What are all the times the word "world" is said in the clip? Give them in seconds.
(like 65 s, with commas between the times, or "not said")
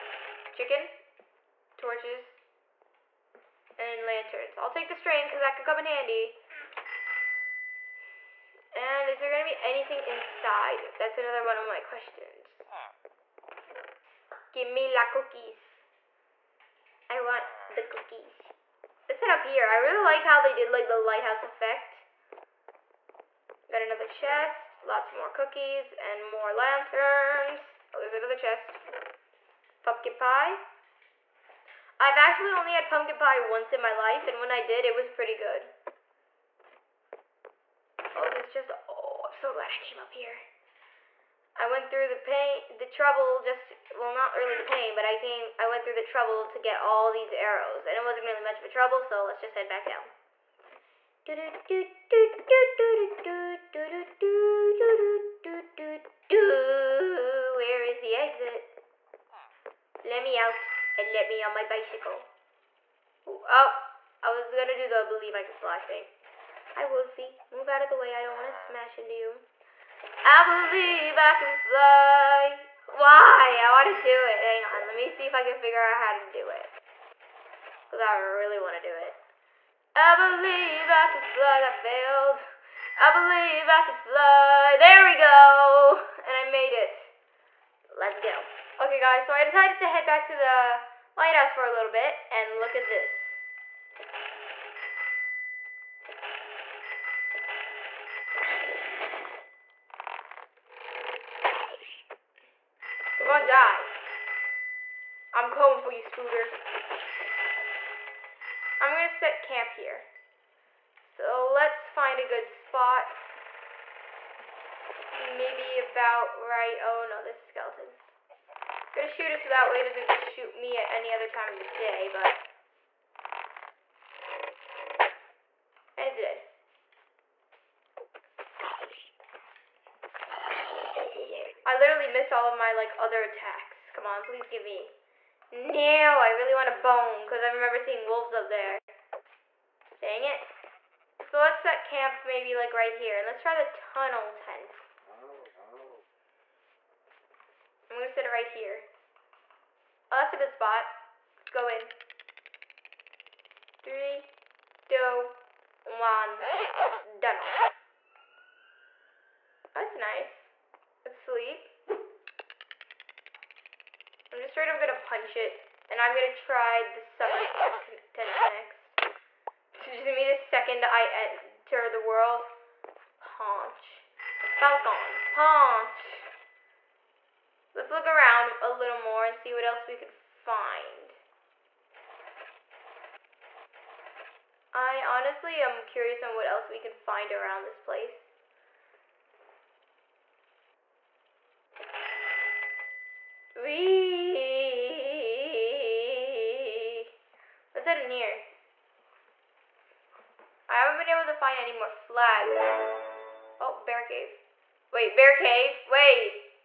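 171 s.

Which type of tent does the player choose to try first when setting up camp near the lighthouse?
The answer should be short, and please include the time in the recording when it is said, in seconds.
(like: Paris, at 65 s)
Tunnel tent, at 143 s.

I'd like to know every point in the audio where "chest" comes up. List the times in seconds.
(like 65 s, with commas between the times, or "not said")
24 s, 28 s.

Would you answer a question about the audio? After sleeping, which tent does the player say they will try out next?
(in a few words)
Summer tent.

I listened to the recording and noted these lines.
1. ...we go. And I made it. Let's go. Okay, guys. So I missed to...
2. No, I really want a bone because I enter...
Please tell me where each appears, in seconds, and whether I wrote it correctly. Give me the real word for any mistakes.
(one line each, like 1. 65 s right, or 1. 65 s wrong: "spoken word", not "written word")
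1. 85 s wrong: "decided", not "missed"
2. 135 s wrong: "remember", not "enter".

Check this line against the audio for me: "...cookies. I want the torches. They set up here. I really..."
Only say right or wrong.
wrong.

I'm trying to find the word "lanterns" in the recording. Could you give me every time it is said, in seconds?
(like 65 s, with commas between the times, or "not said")
4 s, 26 s.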